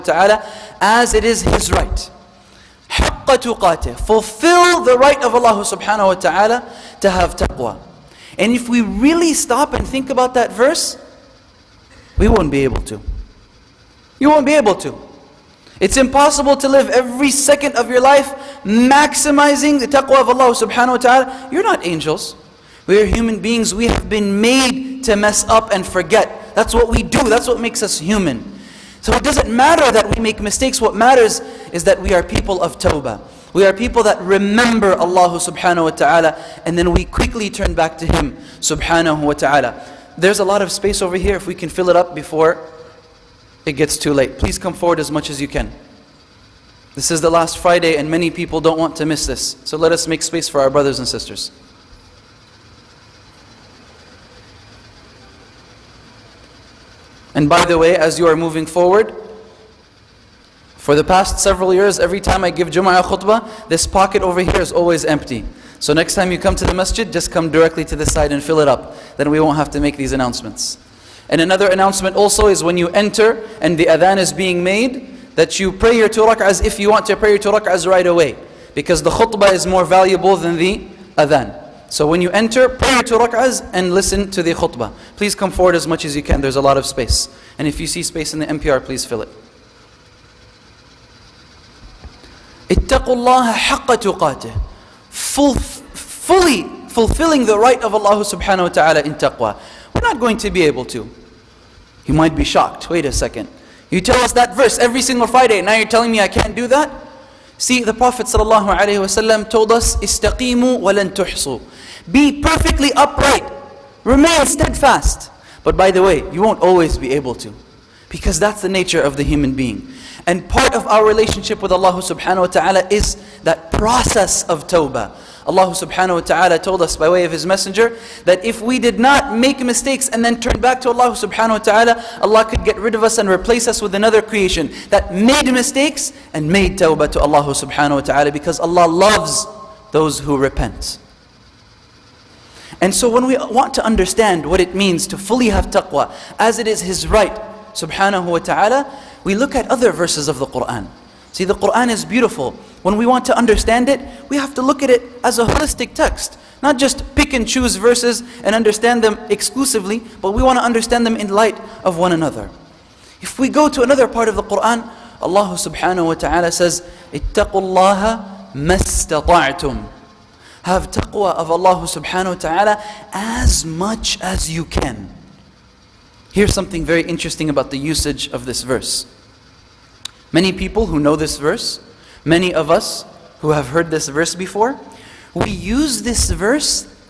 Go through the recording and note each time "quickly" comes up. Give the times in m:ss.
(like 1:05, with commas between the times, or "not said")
0:37.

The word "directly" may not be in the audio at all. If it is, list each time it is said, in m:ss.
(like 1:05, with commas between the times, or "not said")
1:07.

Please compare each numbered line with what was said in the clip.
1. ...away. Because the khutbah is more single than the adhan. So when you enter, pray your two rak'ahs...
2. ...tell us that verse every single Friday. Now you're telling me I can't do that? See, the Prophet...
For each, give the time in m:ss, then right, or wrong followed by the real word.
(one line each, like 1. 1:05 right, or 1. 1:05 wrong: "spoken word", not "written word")
1. 1:18 wrong: "valuable", not "single"
2. 1:44 right.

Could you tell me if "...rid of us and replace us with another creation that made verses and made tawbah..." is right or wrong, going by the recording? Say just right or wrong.
wrong.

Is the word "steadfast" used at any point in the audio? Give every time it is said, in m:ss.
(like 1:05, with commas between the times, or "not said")
1:54.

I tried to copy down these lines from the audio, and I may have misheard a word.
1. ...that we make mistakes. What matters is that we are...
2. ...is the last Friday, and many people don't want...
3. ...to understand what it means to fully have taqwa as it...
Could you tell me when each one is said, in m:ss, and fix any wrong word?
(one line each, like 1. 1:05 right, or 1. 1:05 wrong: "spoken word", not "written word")
1. 0:29 right
2. 0:47 right
3. 2:23 right.